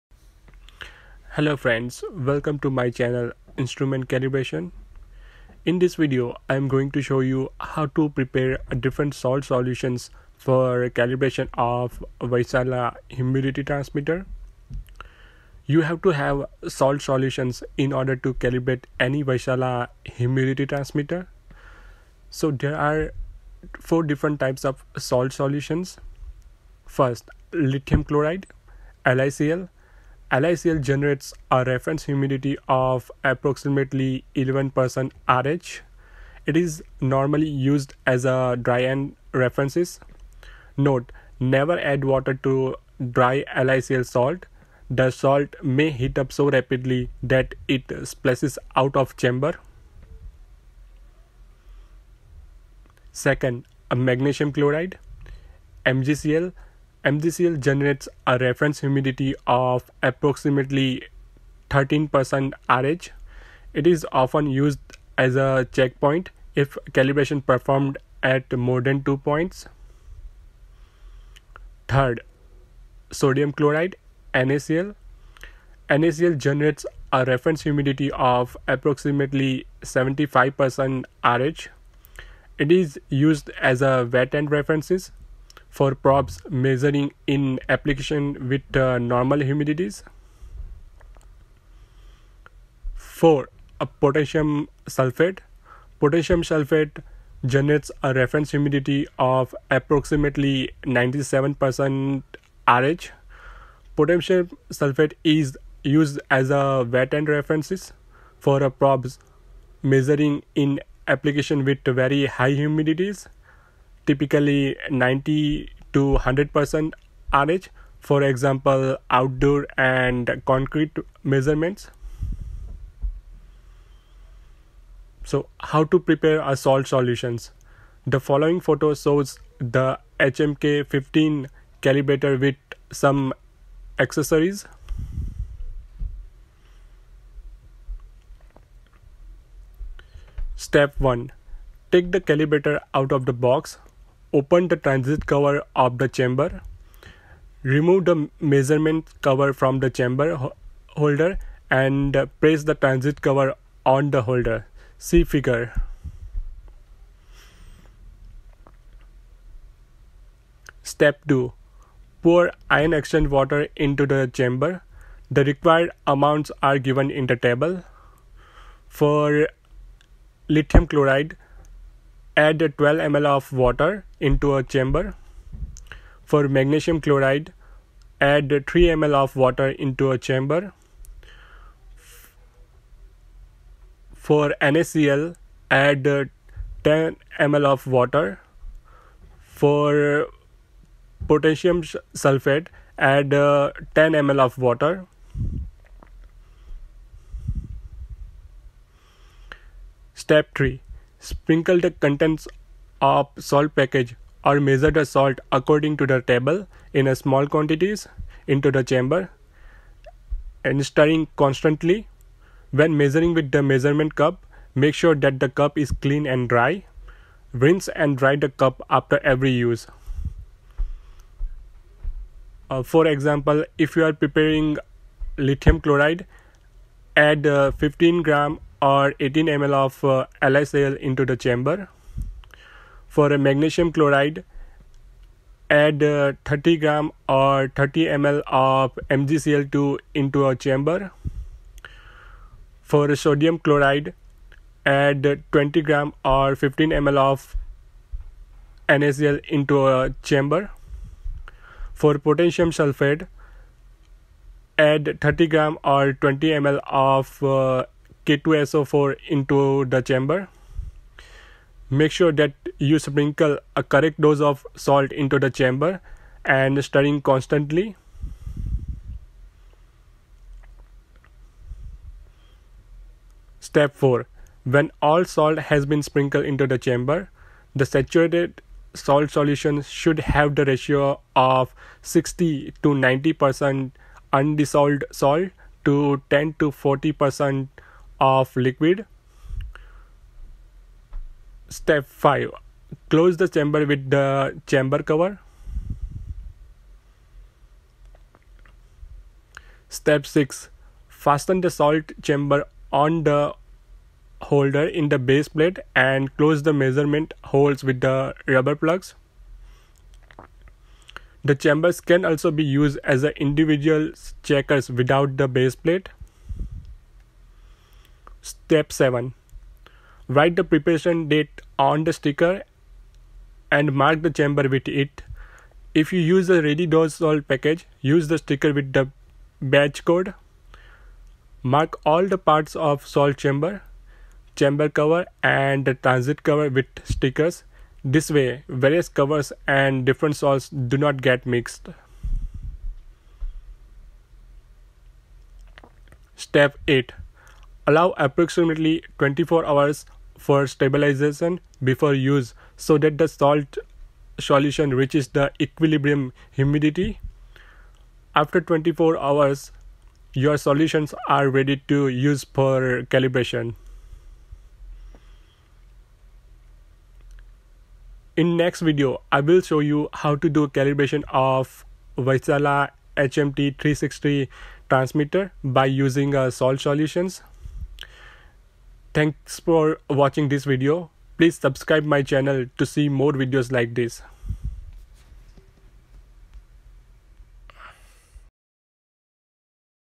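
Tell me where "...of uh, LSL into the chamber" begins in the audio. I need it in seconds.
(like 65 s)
229 s.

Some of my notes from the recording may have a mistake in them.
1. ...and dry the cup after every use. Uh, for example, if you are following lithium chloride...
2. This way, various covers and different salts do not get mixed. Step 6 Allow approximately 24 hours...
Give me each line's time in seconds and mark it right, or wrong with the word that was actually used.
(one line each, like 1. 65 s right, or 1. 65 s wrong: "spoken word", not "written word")
1. 217 s wrong: "preparing", not "following"
2. 338 s wrong: "8", not "6".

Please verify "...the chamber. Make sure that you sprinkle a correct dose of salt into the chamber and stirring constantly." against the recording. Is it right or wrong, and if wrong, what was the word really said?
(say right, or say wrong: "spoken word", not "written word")
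right.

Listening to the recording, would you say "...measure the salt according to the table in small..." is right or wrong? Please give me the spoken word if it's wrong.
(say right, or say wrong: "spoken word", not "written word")
right.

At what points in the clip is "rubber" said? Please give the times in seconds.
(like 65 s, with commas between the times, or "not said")
308 s.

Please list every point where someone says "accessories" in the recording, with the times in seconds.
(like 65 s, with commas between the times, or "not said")
133 s.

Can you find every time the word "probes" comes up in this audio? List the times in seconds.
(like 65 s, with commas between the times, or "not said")
85 s, 108 s.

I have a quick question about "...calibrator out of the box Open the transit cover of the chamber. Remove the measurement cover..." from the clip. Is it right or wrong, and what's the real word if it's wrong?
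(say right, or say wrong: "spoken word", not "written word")
right.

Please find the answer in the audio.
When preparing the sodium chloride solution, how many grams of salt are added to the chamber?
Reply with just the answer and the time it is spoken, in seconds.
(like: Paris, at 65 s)
20 grams, at 245 s.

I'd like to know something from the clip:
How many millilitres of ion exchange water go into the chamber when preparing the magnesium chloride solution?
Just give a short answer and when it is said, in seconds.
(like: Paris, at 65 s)
3 ml, at 178 s.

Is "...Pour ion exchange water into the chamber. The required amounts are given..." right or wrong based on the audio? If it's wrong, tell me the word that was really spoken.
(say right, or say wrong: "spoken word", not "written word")
right.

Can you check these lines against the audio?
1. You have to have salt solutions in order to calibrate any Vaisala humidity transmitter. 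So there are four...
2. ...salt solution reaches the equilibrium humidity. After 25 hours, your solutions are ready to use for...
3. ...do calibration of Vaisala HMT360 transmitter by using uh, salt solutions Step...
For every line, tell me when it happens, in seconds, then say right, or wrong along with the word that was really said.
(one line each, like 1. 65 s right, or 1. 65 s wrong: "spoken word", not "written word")
1. 15 s right
2. 353 s wrong: "24", not "25"
3. 370 s wrong: "Thanks", not "Step".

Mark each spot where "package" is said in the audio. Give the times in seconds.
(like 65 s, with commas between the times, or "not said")
203 s, 327 s.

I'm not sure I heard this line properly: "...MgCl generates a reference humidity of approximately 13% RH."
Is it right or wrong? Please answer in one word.
right.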